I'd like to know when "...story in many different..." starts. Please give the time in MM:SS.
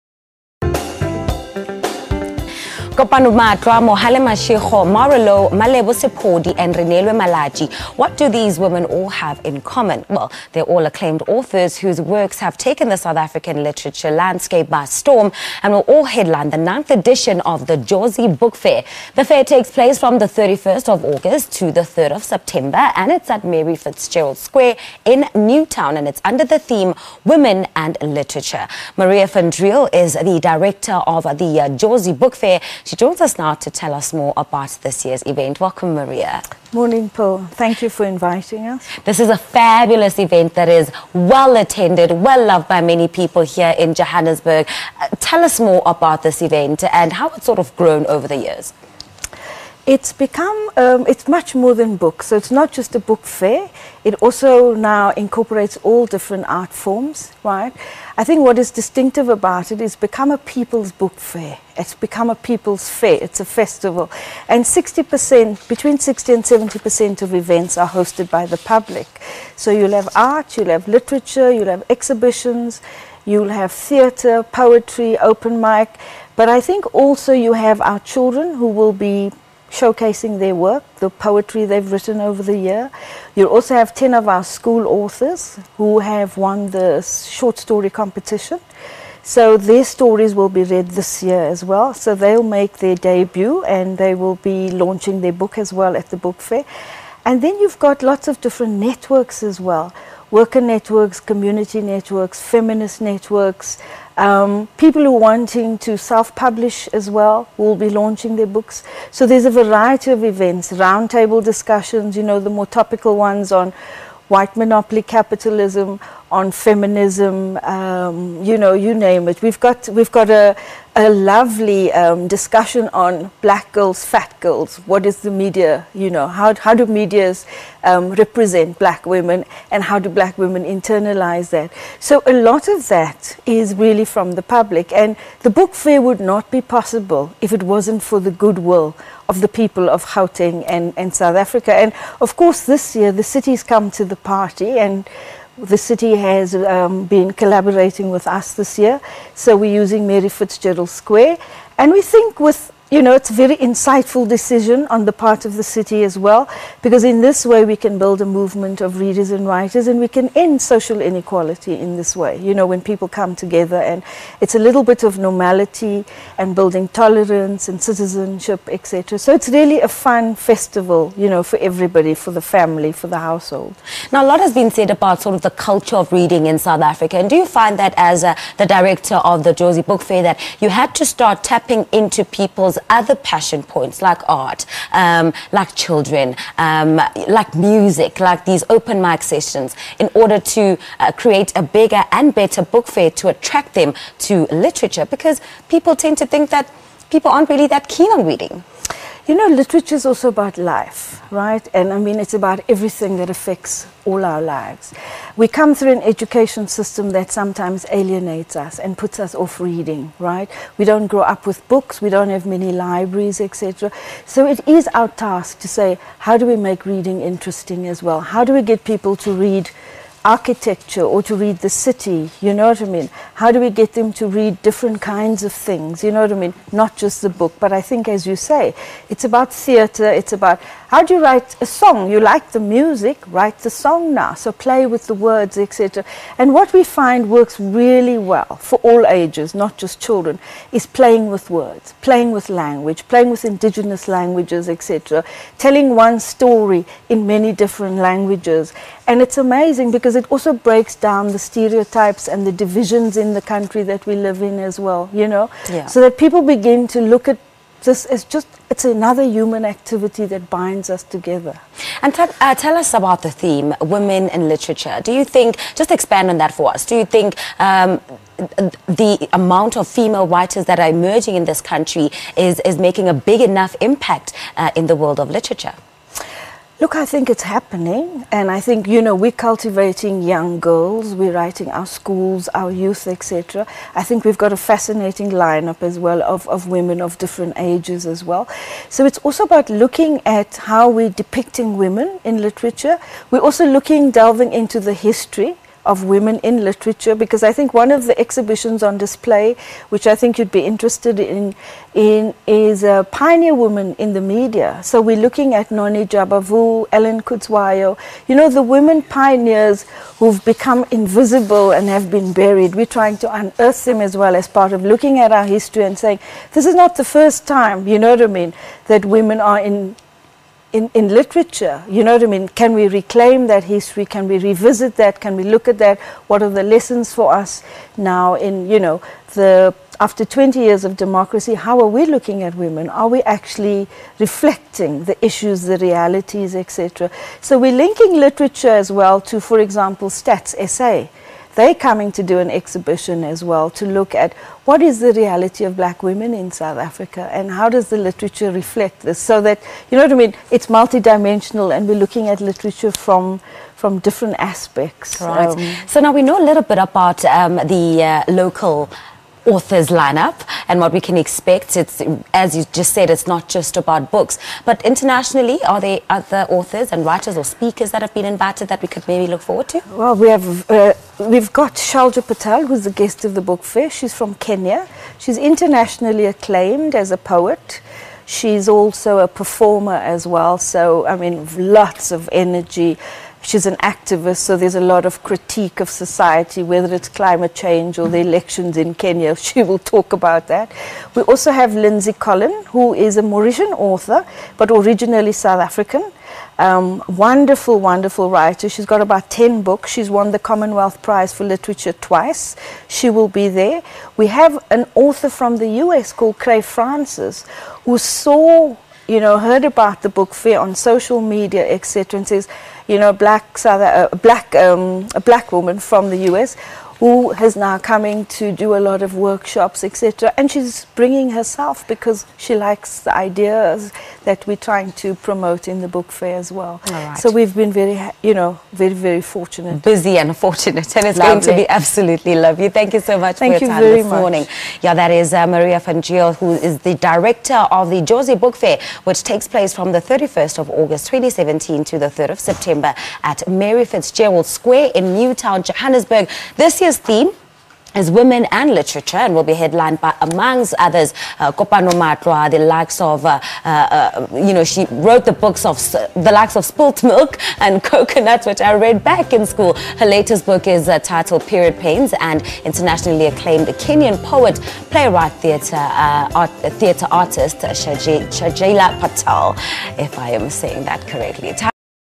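04:06.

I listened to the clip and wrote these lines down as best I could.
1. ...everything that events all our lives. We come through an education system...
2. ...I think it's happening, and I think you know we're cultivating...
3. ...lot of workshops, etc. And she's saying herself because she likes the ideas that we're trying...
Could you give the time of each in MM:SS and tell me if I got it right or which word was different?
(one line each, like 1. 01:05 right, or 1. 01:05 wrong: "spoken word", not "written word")
1. 03:22 wrong: "affects", not "events"
2. 04:36 right
3. 06:58 wrong: "bringing", not "saying".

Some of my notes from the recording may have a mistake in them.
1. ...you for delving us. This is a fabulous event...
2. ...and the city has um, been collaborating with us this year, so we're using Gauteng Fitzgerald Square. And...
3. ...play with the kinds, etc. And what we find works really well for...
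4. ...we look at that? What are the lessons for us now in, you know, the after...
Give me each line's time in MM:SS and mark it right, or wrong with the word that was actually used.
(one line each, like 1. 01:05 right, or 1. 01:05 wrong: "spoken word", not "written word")
1. 00:37 wrong: "inviting", not "delving"
2. 02:24 wrong: "Mary", not "Gauteng"
3. 03:54 wrong: "words", not "kinds"
4. 05:25 right.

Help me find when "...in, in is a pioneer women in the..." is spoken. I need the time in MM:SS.
05:01.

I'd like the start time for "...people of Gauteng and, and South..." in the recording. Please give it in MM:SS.
02:19.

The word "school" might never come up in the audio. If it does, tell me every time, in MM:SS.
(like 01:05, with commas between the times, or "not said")
01:24, 04:41, 07:39.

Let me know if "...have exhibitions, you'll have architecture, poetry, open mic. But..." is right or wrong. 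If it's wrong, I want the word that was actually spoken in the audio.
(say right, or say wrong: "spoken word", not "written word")
wrong: "theatre", not "architecture".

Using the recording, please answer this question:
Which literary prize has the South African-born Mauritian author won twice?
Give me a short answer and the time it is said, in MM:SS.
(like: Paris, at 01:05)
Commonwealth Prize for Literature, at 06:40.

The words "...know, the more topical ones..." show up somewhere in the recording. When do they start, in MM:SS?
01:52.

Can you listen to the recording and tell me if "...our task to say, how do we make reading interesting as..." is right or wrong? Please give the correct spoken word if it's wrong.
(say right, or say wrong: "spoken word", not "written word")
right.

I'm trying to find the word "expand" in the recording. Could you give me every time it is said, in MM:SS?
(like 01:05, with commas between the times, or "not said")
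04:25.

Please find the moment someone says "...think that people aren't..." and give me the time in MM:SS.
03:16.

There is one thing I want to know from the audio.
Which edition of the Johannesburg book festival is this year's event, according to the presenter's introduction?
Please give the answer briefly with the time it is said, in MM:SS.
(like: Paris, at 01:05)
ninth, at 00:16.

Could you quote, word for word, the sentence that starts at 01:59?
We've got, we've got a, a lovely um, discussion on black girls, fat girls.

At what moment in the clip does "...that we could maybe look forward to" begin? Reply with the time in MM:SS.
06:08.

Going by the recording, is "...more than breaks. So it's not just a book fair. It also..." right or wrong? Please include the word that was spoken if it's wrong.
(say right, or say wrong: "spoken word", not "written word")
wrong: "books", not "breaks".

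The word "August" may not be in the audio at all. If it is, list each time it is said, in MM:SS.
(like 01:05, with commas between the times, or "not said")
00:21, 07:20.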